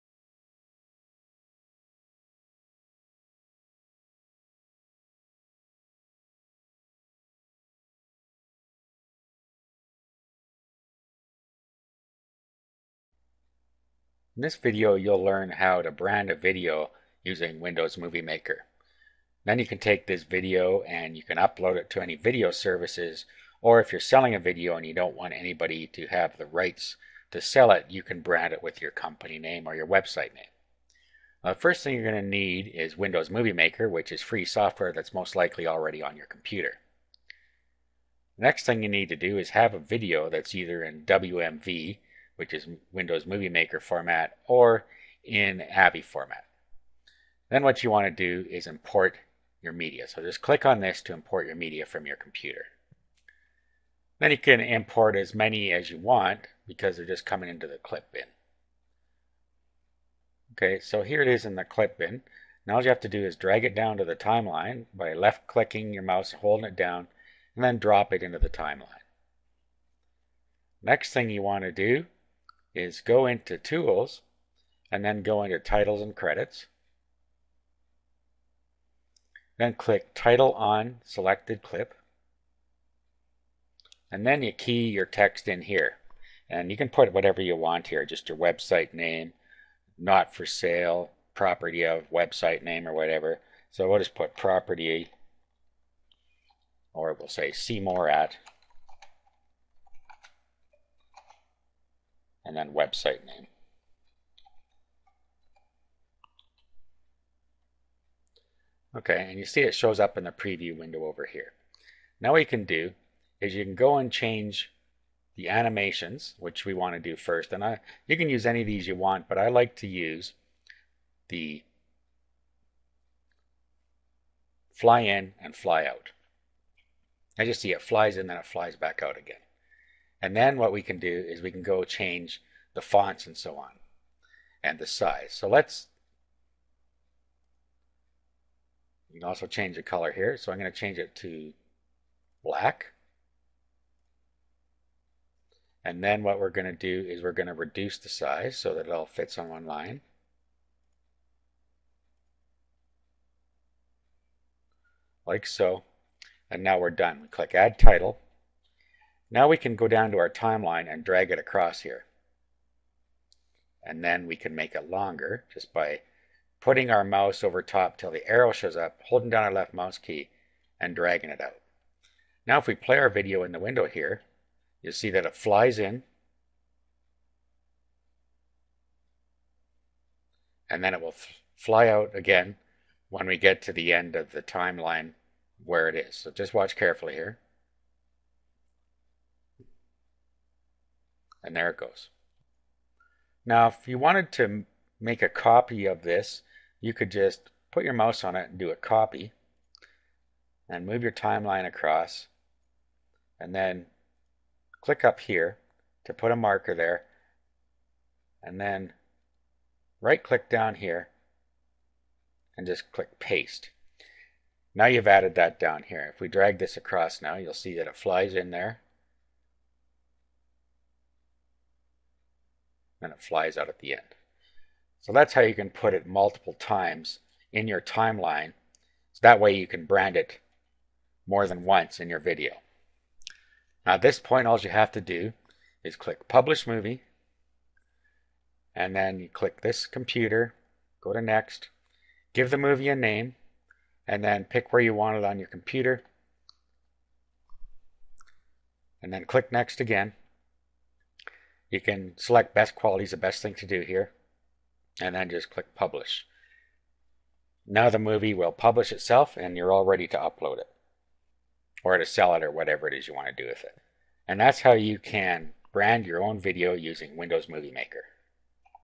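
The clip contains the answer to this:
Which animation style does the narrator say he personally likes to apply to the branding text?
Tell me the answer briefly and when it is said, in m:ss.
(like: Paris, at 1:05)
Fly in and fly out, at 2:04.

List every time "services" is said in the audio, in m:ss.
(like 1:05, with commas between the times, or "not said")
0:22.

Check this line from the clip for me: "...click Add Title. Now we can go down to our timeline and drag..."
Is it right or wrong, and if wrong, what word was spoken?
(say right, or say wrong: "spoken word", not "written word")
right.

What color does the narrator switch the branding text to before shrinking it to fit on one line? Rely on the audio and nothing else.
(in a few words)
Black.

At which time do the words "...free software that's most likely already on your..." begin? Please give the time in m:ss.
0:34.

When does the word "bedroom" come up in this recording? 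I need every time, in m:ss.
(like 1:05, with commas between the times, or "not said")
not said.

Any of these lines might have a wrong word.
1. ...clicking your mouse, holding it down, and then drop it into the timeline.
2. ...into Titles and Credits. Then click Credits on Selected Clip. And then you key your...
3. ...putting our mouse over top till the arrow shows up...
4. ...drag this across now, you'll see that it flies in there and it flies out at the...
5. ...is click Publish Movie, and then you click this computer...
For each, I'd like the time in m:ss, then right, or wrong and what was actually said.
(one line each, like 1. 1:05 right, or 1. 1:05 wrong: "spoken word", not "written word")
1. 1:05 right
2. 1:15 wrong: "Title", not "Credits"
3. 2:46 right
4. 3:36 right
5. 3:55 right.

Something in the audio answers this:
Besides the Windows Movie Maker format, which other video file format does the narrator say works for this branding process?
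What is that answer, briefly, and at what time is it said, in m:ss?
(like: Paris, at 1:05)
AVI, at 0:45.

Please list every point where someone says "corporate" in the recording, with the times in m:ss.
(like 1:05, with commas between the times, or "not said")
not said.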